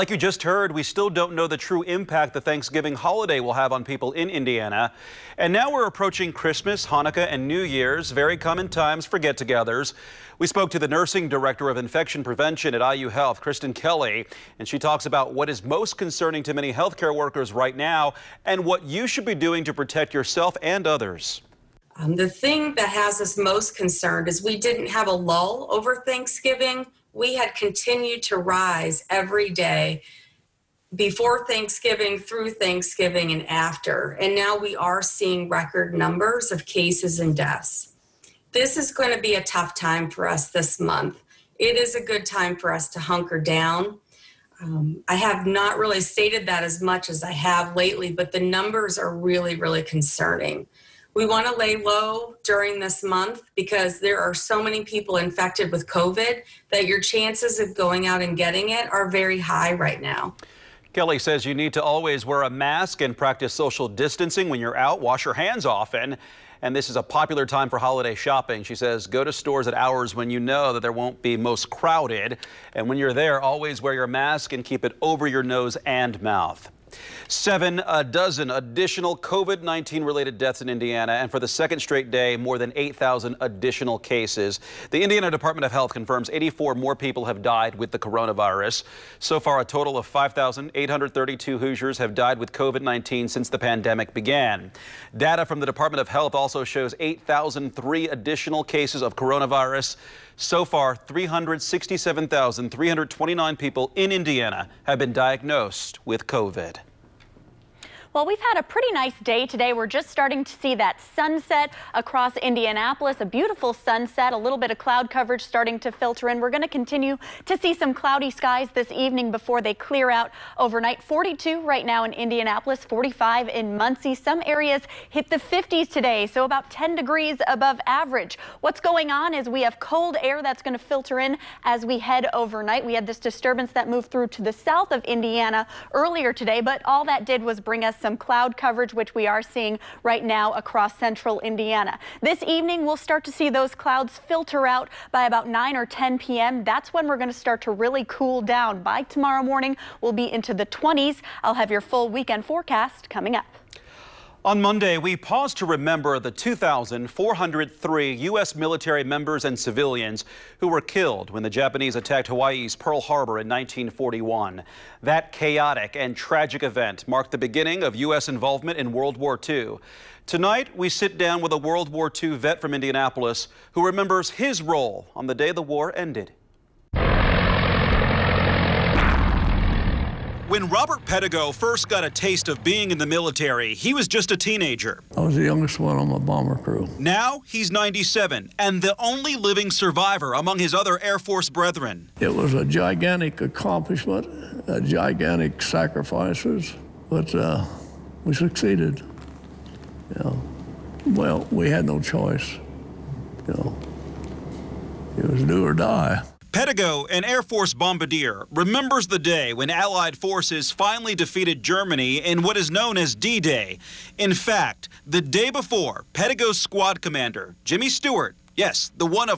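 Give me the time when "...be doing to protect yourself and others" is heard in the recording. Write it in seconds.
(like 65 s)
19 s.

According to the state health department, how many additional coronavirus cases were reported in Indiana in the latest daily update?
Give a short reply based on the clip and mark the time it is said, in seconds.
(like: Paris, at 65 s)
8,003, at 97 s.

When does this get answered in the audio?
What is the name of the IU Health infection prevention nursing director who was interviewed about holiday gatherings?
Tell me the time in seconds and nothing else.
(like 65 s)
13 s.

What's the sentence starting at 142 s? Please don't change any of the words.
This evening, we'll start to see those clouds filter out by about 9 or 10 p.m.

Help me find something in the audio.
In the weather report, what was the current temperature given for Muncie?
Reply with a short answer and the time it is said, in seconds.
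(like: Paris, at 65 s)
45, at 122 s.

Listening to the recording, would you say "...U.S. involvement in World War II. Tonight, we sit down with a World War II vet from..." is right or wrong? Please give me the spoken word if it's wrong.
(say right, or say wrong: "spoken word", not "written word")
right.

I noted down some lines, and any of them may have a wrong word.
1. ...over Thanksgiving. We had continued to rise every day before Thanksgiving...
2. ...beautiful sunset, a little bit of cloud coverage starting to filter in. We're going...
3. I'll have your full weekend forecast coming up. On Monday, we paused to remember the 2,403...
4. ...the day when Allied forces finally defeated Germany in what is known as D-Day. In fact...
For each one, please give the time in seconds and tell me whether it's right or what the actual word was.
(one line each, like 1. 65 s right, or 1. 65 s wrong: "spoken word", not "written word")
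1. 25 s right
2. 113 s right
3. 151 s right
4. 209 s right.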